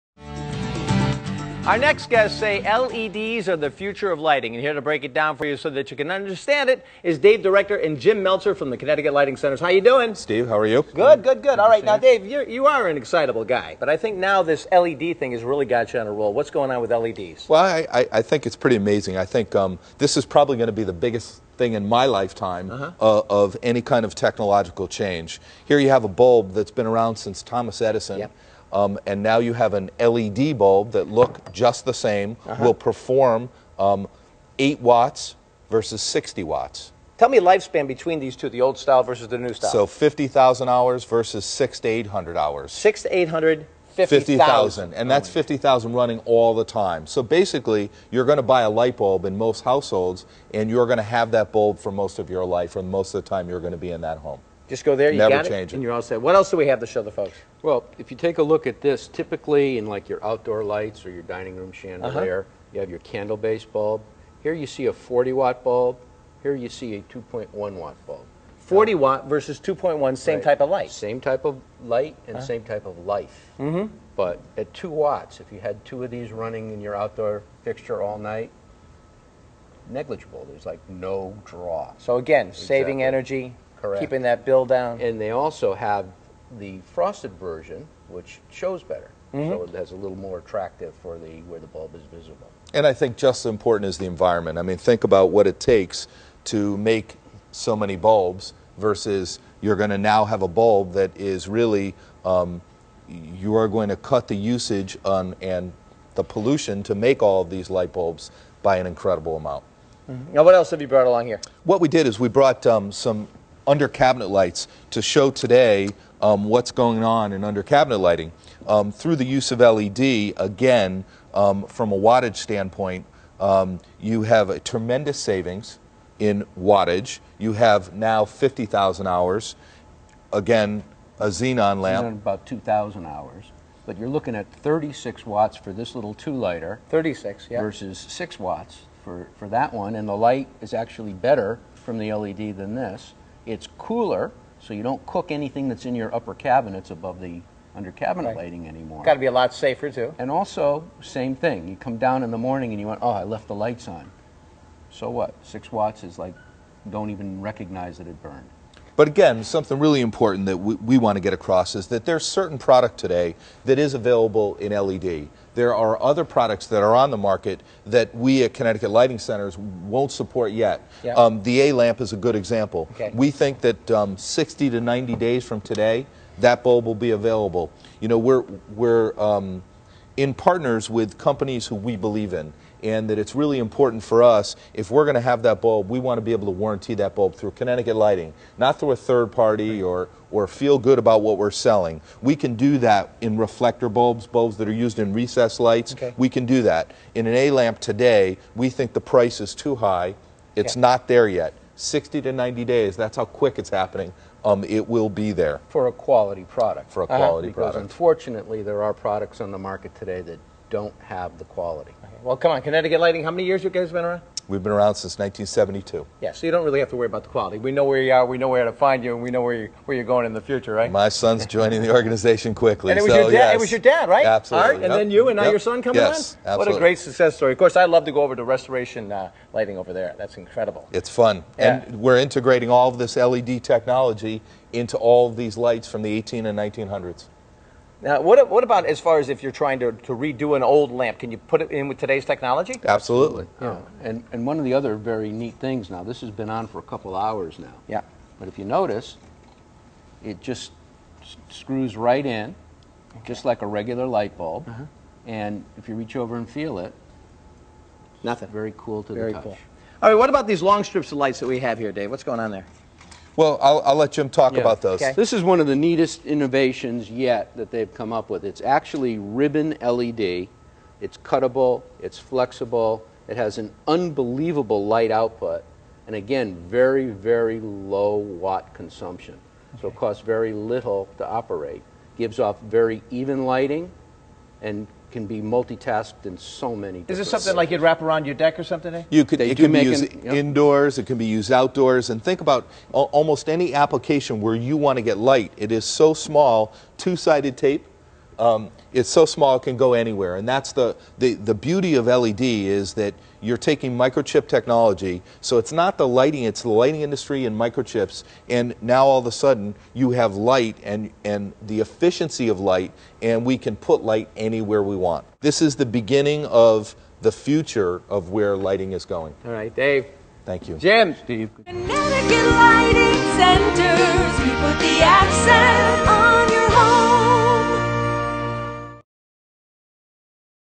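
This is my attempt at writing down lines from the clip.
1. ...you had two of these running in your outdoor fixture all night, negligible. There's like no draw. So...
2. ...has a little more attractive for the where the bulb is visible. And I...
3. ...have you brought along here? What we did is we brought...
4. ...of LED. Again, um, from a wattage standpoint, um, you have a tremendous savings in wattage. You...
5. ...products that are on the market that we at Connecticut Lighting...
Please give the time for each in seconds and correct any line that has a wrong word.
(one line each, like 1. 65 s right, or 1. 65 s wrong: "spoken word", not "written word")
1. 75 s right
2. 89 s right
3. 110 s right
4. 119 s right
5. 166 s right.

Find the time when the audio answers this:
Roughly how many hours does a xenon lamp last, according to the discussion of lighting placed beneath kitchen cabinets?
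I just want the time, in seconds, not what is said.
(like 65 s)
132 s.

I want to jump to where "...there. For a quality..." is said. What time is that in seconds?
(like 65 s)
205 s.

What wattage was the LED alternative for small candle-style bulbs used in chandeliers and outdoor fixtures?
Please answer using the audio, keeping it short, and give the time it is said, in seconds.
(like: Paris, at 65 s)
2.1 watts, at 67 s.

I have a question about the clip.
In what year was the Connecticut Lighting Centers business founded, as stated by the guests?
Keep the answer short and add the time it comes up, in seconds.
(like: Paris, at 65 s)
1972, at 215 s.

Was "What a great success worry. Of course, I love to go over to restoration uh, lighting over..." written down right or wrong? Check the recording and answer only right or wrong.
wrong.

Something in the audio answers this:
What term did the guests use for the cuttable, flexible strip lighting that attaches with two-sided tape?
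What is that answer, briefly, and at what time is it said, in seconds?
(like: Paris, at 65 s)
ribbon LED, at 269 s.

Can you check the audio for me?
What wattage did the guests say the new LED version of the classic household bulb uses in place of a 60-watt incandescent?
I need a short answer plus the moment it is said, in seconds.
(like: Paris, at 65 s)
8 watts, at 34 s.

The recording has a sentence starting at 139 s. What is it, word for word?
And the light is actually better from the LED than this.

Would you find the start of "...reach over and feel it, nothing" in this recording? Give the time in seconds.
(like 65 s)
255 s.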